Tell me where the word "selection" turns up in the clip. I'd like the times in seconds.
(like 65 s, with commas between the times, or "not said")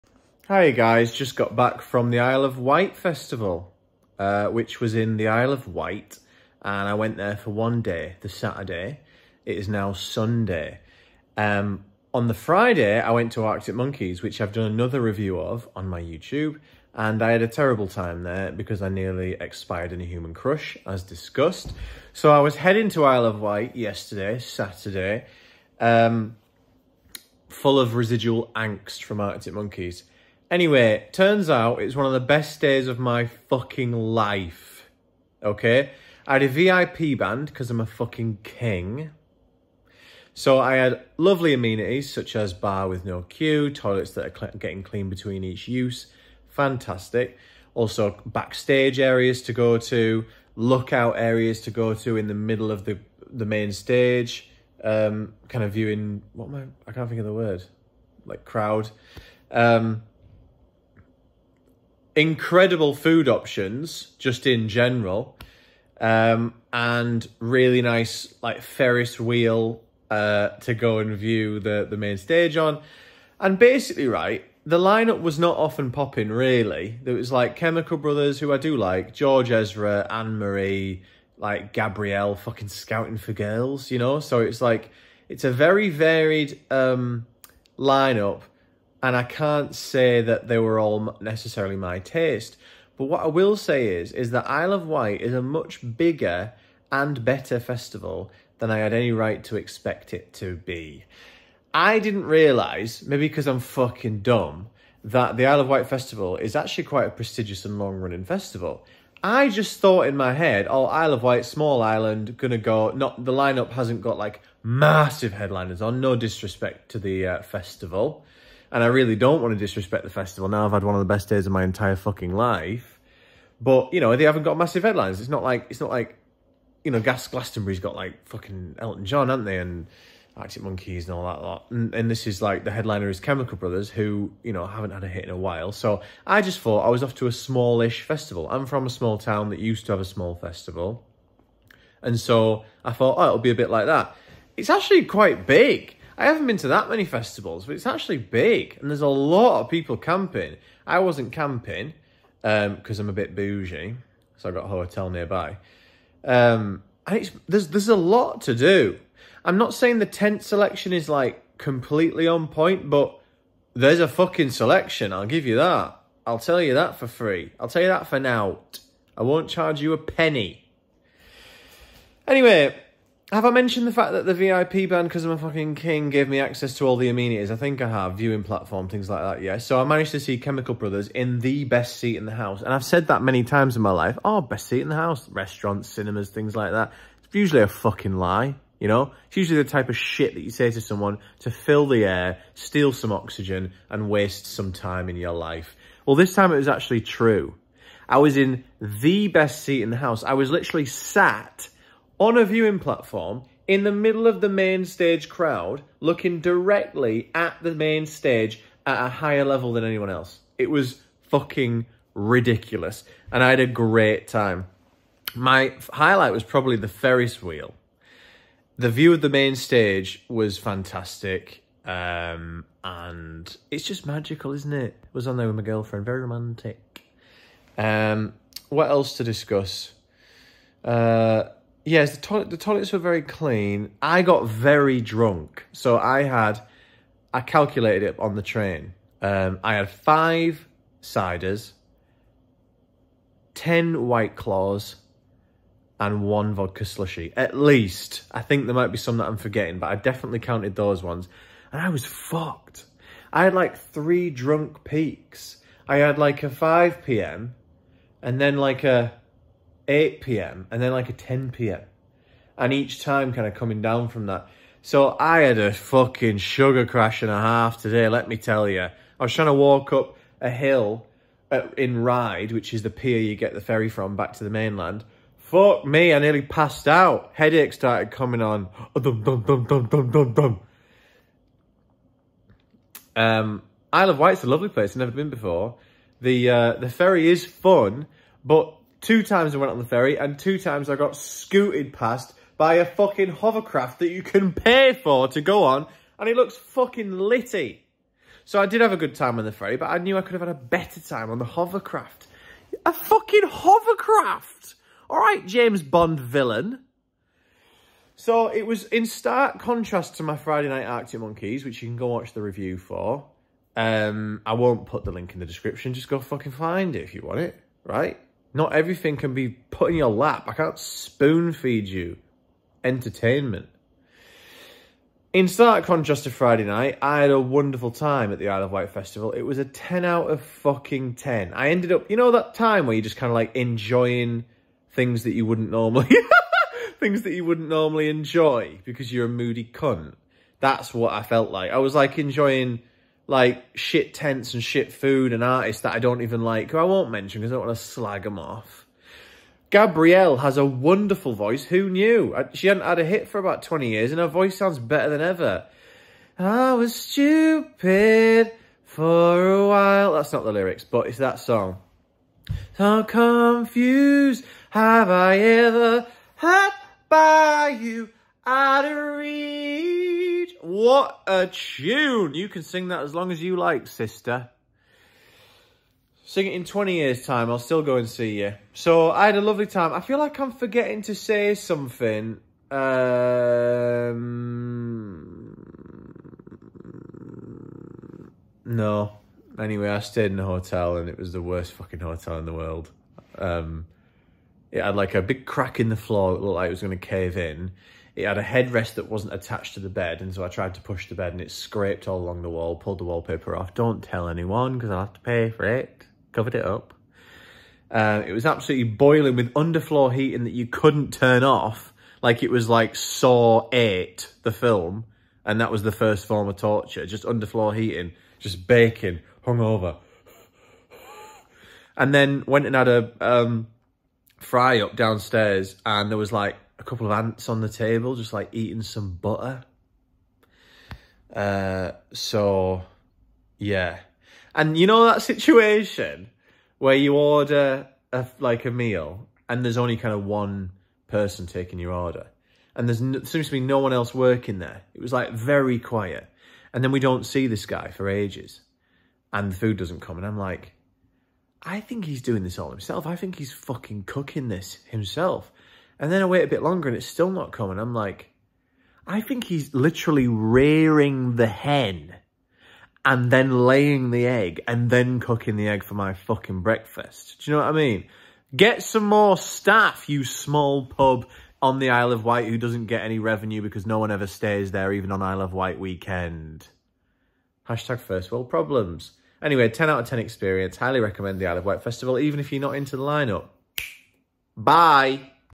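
160 s, 164 s.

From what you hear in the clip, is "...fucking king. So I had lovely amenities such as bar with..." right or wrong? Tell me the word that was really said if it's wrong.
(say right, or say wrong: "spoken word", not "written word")
right.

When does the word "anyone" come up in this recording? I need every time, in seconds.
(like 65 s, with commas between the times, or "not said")
209 s, 404 s.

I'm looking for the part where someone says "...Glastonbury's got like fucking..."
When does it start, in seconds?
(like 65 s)
127 s.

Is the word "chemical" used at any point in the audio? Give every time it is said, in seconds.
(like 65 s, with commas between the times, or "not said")
77 s, 133 s, 180 s.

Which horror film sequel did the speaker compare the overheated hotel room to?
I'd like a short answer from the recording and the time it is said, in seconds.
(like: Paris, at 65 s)
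Saw 8, at 412 s.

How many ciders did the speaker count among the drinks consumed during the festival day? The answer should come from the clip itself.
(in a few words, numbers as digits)
5.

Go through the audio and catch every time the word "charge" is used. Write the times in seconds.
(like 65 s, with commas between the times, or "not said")
169 s.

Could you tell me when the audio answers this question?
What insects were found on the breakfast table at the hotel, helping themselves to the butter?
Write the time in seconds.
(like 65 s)
427 s.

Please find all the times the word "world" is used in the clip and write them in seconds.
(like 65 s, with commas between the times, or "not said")
392 s, 478 s.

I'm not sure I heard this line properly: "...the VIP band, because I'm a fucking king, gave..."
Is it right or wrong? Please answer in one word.
right.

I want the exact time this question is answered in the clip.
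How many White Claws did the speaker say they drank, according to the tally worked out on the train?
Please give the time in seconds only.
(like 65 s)
243 s.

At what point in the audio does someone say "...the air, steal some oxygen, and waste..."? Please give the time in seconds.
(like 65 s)
191 s.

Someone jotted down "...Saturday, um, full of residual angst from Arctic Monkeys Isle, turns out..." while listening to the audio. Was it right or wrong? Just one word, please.
wrong.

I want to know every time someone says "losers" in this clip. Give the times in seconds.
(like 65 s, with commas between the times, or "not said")
not said.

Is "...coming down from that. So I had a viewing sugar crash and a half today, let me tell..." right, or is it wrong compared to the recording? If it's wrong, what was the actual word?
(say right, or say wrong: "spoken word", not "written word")
wrong: "fucking", not "viewing".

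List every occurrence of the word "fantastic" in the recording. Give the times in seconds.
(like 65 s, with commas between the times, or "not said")
46 s, 220 s.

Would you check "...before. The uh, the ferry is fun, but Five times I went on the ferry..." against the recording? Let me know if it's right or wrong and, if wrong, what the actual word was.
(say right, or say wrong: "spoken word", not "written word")
wrong: "Two", not "Five".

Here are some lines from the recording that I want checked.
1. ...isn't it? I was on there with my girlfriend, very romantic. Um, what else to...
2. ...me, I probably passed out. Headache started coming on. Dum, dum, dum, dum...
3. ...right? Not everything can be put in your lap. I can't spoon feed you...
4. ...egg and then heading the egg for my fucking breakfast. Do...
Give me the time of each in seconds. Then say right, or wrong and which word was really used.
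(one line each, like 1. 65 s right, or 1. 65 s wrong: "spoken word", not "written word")
1. 224 s right
2. 275 s wrong: "nearly", not "probably"
3. 317 s right
4. 464 s wrong: "cooking", not "heading".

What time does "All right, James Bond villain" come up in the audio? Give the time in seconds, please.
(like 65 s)
305 s.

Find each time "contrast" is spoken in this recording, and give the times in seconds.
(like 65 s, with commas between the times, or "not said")
309 s, 325 s.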